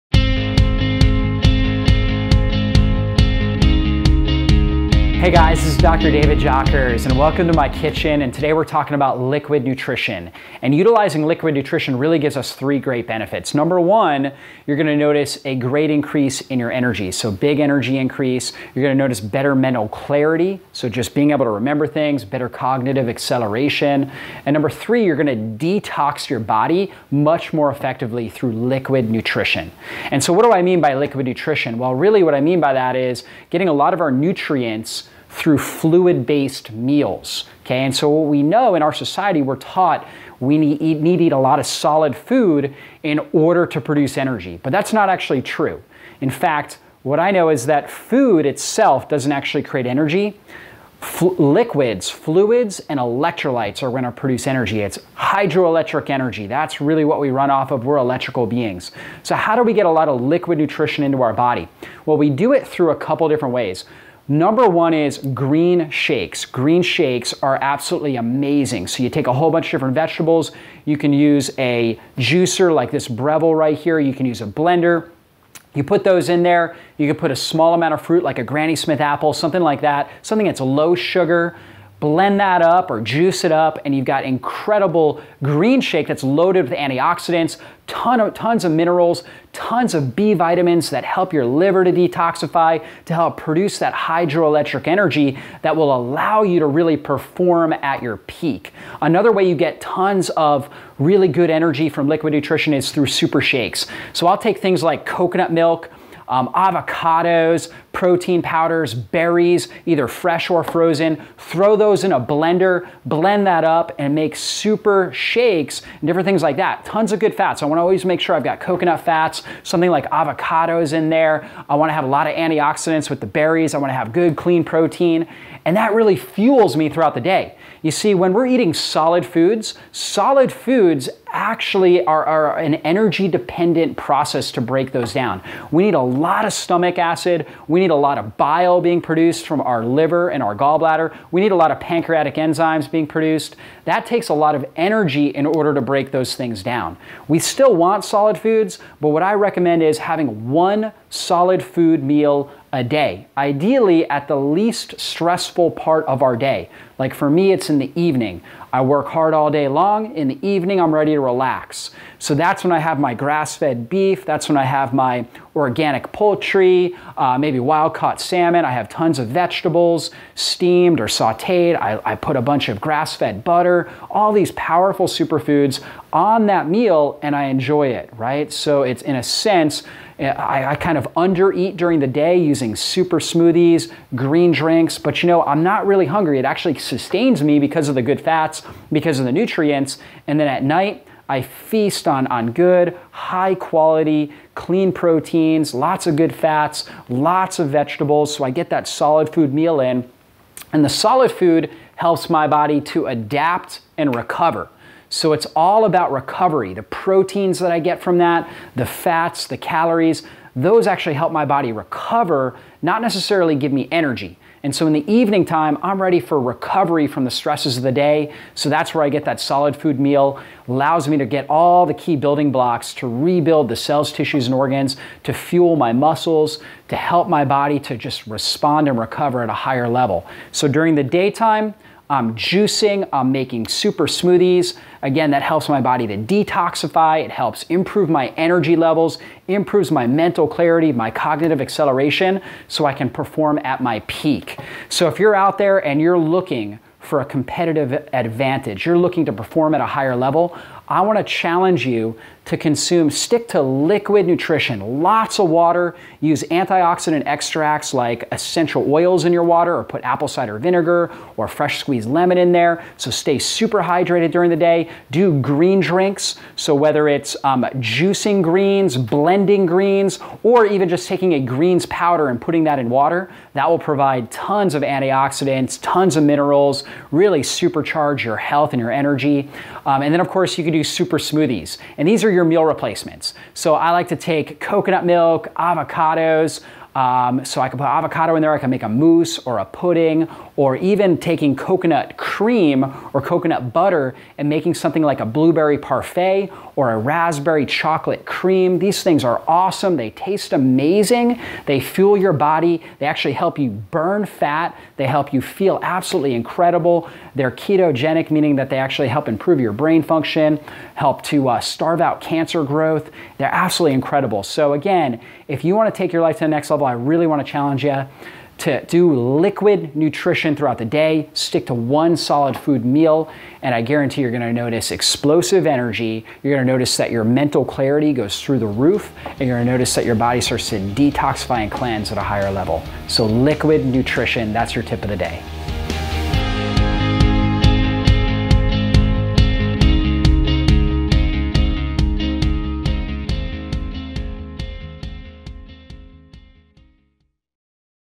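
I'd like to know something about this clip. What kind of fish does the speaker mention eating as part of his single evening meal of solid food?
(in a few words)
wild caught salmon.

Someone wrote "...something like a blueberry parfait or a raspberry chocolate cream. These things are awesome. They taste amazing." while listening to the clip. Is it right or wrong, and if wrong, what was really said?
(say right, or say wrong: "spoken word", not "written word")
right.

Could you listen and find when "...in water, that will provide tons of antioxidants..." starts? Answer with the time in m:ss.
4:32.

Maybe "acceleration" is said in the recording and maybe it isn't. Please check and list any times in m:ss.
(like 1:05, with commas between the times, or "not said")
0:23, 4:01.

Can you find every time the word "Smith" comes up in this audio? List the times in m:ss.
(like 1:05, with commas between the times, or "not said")
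1:18.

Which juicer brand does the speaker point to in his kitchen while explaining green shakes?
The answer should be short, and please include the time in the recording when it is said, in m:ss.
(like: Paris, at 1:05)
Breville, at 1:13.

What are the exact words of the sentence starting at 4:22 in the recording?
So stay super hydrated during the day.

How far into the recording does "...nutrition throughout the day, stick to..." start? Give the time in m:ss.
5:19.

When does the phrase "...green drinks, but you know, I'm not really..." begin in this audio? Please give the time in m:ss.
3:04.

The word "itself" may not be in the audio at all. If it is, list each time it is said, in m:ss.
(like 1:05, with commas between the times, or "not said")
0:48.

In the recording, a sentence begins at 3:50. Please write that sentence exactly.
So during the daytime, I'm juicing, I'm making super smoothies.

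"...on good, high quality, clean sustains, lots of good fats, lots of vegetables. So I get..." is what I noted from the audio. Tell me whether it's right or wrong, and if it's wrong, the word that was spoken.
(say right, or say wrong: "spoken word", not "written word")
wrong: "proteins", not "sustains".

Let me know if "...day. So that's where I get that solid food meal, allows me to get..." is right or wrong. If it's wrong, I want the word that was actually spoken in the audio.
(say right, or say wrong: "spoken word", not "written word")
right.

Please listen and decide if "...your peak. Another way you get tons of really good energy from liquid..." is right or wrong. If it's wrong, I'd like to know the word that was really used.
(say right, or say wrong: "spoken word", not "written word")
right.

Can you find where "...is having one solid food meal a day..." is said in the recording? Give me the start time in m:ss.
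2:29.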